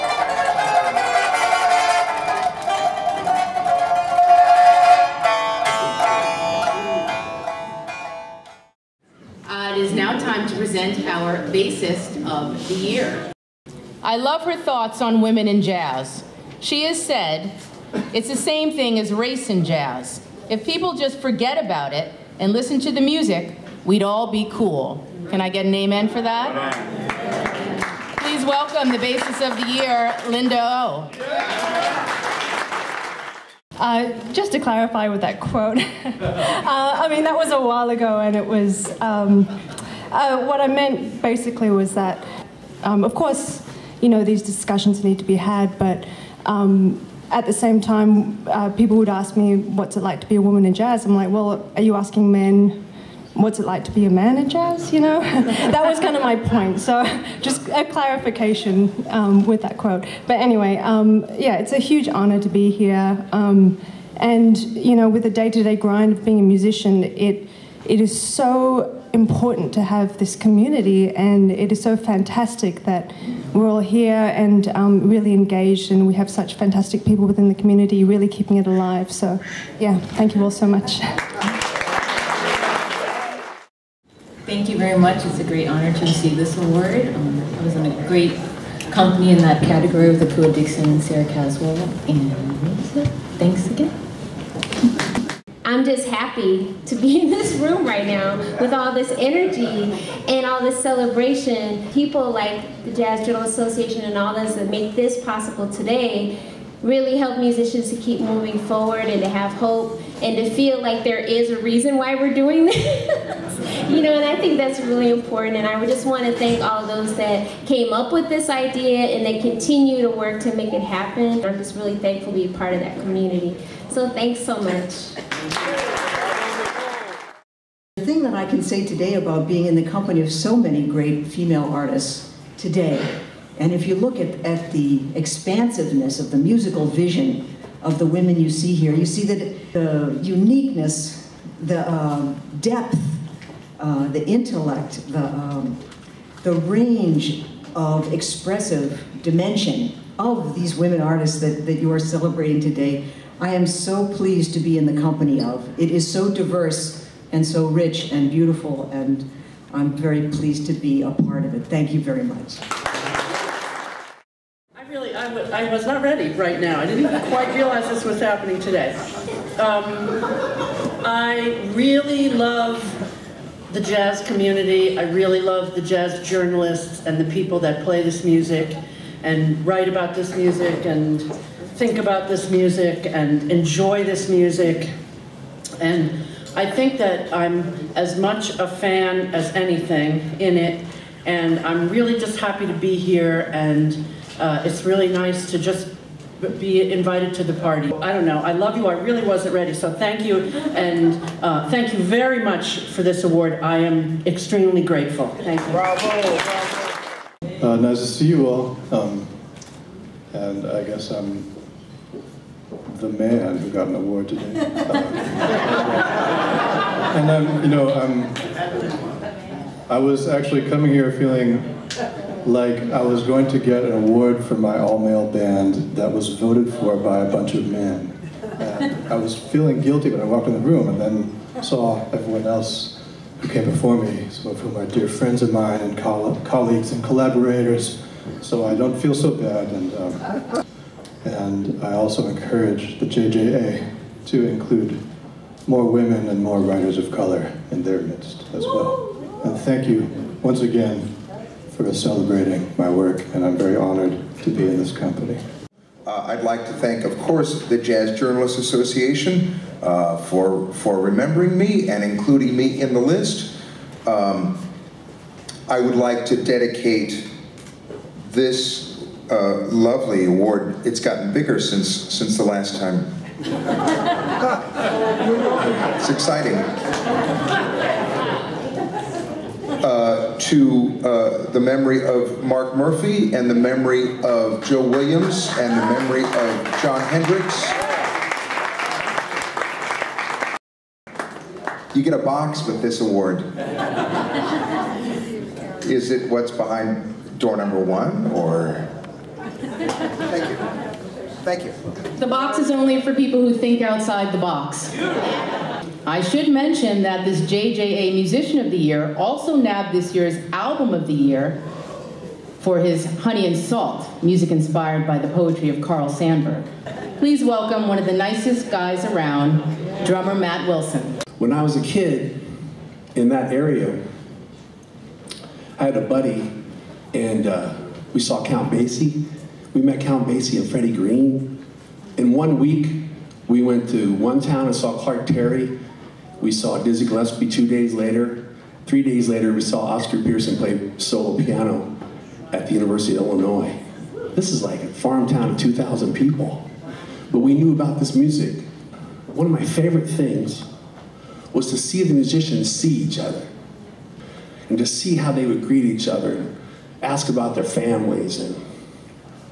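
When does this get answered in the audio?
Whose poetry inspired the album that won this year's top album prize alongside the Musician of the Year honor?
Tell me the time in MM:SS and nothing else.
05:15.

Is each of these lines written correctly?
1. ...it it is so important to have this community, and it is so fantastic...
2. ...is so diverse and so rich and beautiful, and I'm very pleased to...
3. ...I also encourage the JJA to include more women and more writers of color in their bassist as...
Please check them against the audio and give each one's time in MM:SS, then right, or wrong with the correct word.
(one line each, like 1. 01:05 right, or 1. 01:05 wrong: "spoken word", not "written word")
1. 01:07 right
2. 02:35 right
3. 04:01 wrong: "midst", not "bassist".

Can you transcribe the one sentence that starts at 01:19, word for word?
So, yeah, thank you all so much.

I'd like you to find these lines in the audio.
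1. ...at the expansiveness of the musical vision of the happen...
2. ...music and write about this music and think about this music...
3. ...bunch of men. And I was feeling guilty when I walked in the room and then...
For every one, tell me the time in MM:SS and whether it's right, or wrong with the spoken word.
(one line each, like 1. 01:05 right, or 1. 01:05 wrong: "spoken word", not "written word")
1. 02:14 wrong: "women", not "happen"
2. 02:58 right
3. 03:47 right.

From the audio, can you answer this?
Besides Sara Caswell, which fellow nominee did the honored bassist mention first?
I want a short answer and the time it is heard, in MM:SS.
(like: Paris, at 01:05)
Akua Dixon, at 01:30.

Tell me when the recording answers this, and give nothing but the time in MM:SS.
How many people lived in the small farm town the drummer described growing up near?
05:45.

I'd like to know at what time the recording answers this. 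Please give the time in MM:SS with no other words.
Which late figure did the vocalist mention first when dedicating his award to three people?
04:42.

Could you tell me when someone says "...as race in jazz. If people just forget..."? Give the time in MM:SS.
00:18.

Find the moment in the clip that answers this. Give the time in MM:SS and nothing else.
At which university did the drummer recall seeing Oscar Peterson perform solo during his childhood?
05:42.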